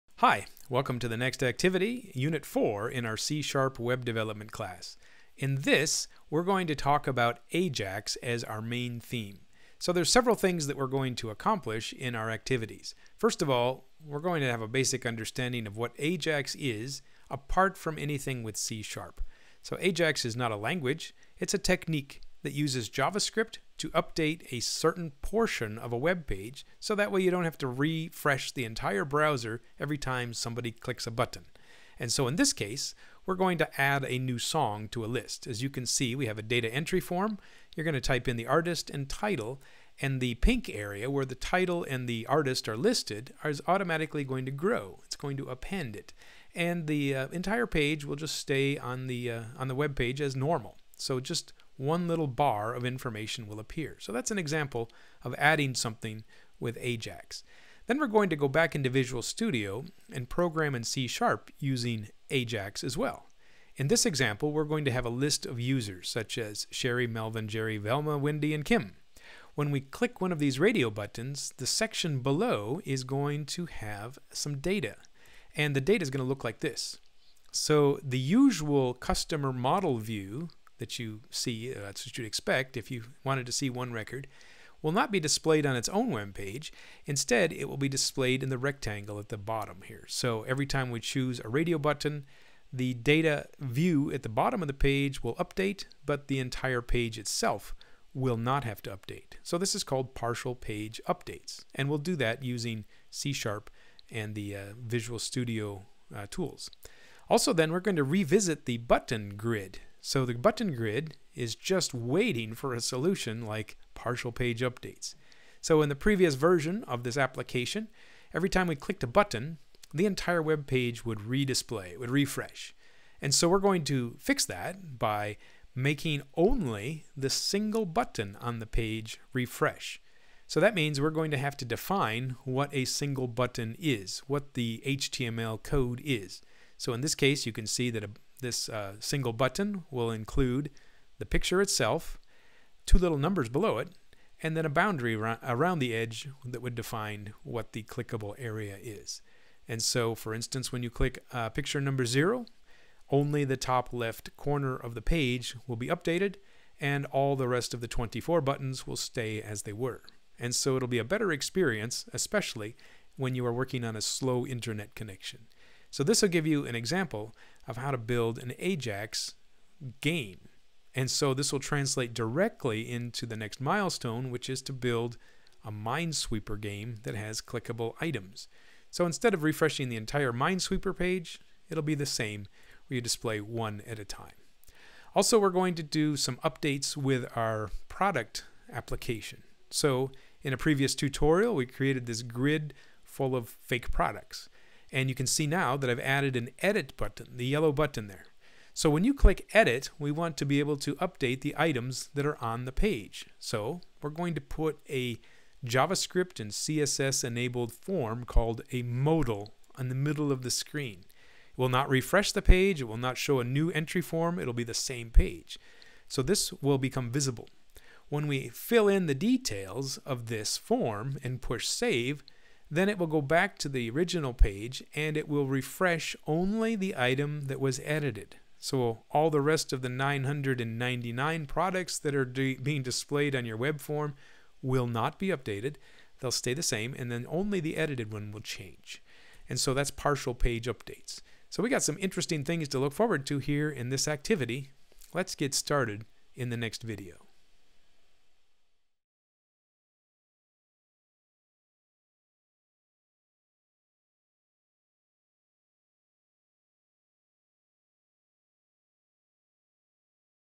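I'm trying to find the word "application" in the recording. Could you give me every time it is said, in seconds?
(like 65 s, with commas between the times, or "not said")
117 s, 188 s.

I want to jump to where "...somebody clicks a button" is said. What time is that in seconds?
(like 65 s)
30 s.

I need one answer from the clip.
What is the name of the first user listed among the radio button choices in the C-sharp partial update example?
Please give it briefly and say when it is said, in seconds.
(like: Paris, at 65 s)
Sherry, at 66 s.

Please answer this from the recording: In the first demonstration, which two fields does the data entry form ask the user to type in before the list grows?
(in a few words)
Artist and title.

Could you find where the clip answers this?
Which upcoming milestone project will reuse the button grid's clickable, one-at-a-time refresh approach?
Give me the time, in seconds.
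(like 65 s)
175 s.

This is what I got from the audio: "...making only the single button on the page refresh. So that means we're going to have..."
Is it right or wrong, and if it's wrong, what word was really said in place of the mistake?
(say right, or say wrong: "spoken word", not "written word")
right.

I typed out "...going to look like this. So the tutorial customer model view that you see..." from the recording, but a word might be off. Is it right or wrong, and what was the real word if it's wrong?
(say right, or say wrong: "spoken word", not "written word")
wrong: "usual", not "tutorial".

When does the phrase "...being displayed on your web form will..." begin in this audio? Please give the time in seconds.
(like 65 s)
232 s.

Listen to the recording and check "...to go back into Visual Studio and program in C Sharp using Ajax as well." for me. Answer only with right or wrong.
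right.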